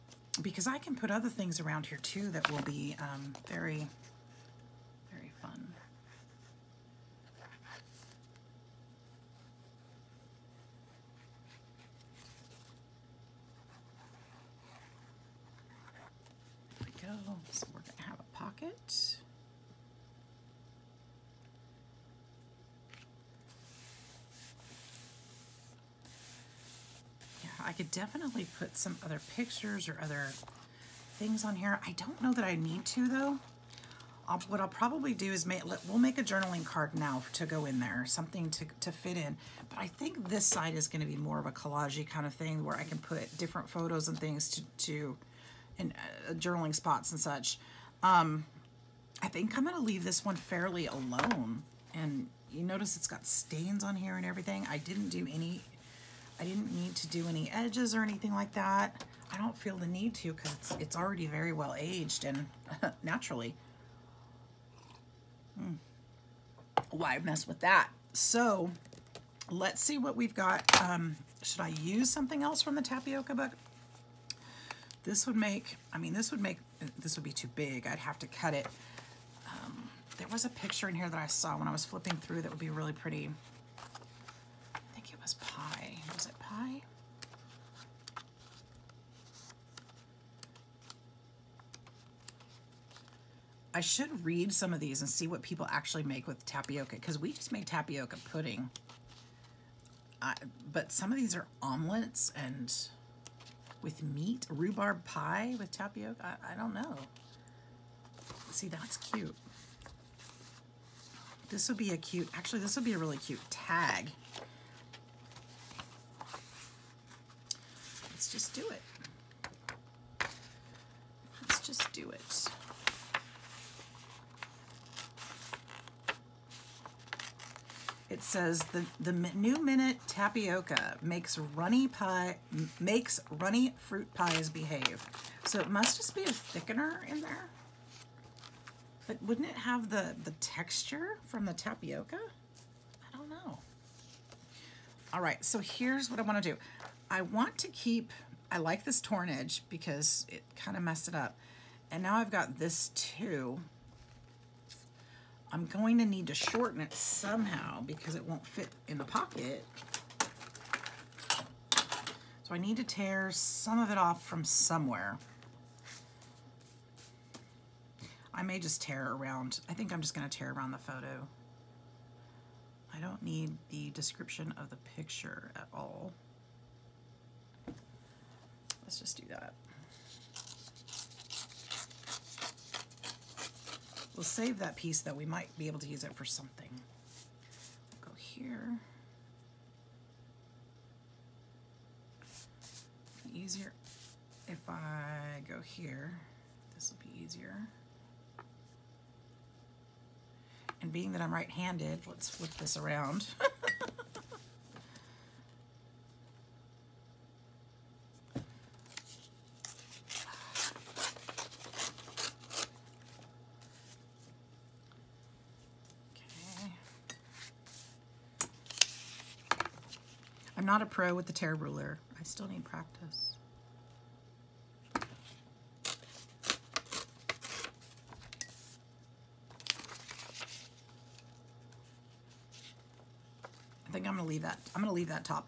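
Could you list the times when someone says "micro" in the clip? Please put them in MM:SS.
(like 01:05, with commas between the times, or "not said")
not said.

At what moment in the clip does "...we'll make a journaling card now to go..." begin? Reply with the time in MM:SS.
00:35.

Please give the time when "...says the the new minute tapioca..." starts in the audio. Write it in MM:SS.
02:08.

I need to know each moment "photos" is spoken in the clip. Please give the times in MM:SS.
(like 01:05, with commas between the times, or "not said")
00:43, 02:50.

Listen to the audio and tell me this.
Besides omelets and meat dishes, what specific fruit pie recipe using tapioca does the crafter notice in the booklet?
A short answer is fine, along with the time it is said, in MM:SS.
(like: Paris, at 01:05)
Rhubarb pie, at 01:44.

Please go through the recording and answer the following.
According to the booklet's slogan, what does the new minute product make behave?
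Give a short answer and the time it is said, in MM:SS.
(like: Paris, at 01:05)
Runny fruit pies, at 02:13.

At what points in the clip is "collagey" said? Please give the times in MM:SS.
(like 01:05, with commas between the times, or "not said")
00:41.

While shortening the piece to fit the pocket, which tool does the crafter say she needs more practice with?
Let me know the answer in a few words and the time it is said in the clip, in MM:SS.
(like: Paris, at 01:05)
Tear ruler, at 03:41.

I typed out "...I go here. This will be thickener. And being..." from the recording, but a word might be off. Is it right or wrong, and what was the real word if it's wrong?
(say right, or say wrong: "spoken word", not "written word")
wrong: "easier", not "thickener".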